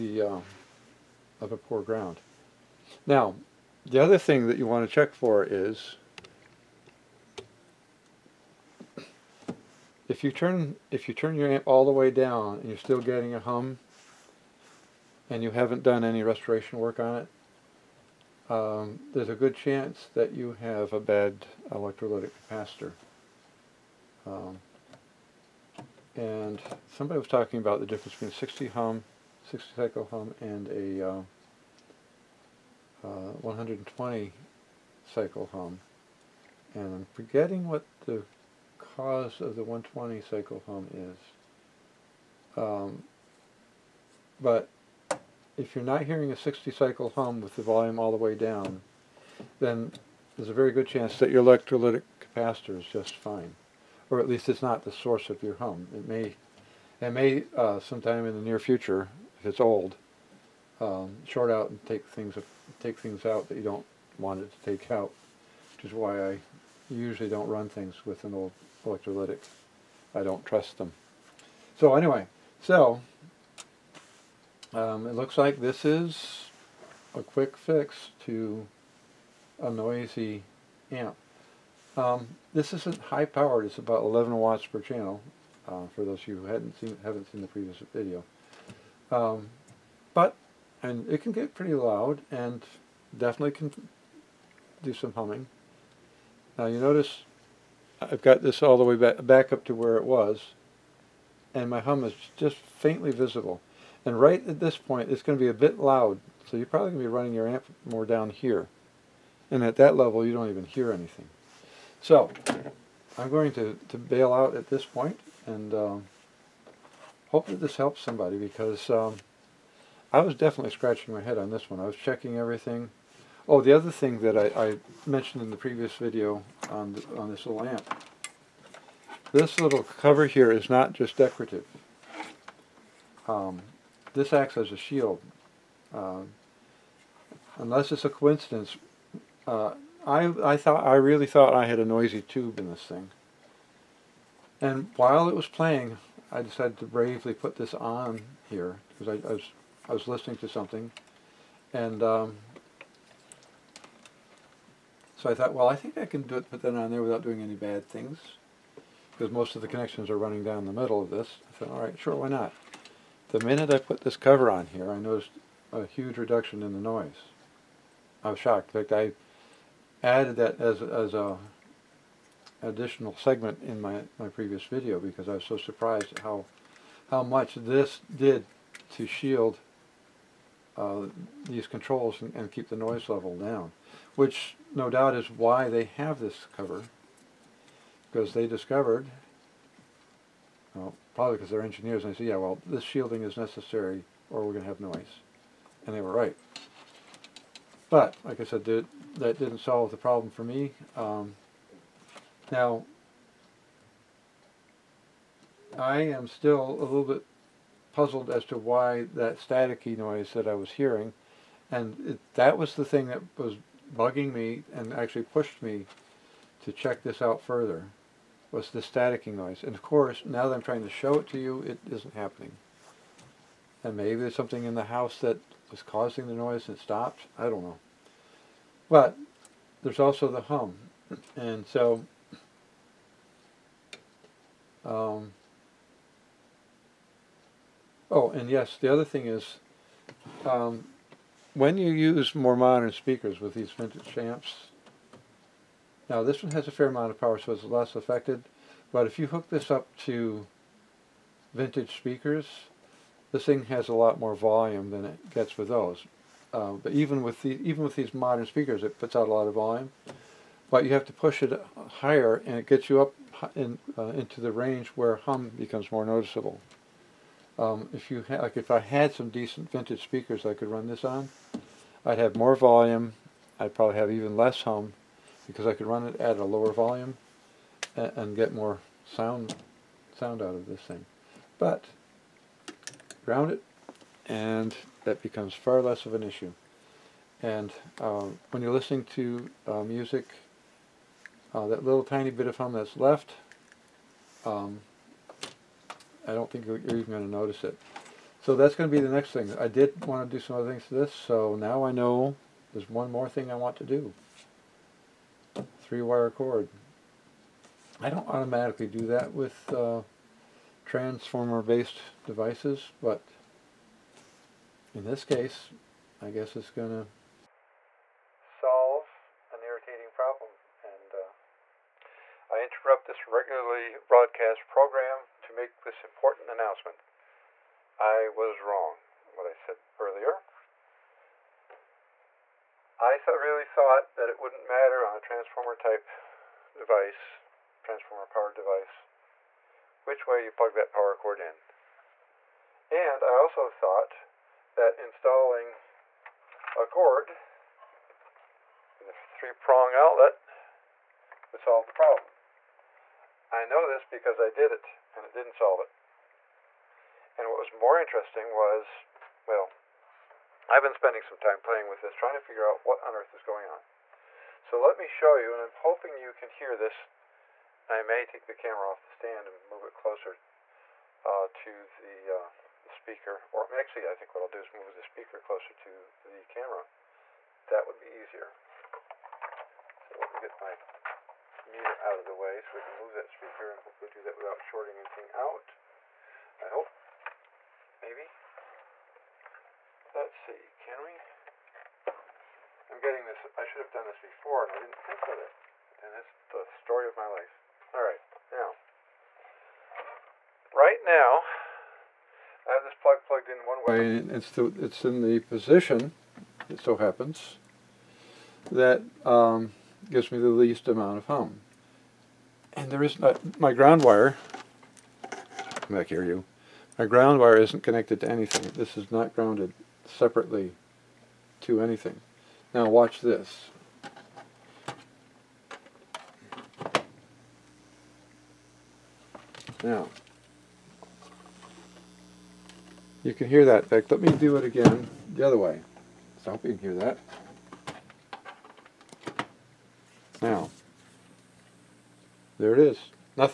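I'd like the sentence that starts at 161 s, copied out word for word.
I thought, all right, sure, why not?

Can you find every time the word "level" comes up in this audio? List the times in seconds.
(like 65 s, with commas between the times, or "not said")
109 s, 183 s.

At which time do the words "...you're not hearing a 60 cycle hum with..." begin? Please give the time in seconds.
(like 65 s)
45 s.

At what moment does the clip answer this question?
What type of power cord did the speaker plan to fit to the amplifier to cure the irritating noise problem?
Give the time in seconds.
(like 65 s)
305 s.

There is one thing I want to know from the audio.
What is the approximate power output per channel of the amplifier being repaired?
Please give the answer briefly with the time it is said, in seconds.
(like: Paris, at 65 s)
11 watts, at 84 s.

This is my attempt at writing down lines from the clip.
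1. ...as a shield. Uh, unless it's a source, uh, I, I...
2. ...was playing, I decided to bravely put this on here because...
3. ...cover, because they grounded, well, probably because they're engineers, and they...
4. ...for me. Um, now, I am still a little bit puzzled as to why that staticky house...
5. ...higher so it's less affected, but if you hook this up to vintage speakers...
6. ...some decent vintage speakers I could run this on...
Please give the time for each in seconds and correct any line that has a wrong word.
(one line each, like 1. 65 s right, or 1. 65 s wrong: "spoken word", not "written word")
1. 134 s wrong: "coincidence", not "source"
2. 145 s right
3. 186 s wrong: "discovered", not "grounded"
4. 200 s wrong: "noise", not "house"
5. 247 s wrong: "power", not "higher"
6. 269 s right.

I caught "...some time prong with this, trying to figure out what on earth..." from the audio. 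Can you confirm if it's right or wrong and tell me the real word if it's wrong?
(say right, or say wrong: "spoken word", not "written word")
wrong: "playing", not "prong".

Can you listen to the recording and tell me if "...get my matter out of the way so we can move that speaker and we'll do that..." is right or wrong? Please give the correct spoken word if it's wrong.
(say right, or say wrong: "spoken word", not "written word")
wrong: "meter", not "matter".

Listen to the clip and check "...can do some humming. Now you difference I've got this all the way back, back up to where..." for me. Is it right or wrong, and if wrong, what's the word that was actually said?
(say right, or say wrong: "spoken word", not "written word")
wrong: "notice", not "difference".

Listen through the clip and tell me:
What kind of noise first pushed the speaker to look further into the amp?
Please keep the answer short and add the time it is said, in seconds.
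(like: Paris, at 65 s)
staticky noise, at 218 s.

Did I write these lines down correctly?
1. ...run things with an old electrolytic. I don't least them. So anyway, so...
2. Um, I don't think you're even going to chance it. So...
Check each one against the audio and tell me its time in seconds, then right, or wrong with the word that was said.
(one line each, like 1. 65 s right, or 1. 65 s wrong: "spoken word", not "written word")
1. 67 s wrong: "trust", not "least"
2. 294 s wrong: "notice", not "chance".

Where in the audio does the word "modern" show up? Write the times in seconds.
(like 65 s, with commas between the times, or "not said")
242 s, 258 s.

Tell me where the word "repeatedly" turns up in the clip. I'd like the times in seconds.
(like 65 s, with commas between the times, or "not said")
not said.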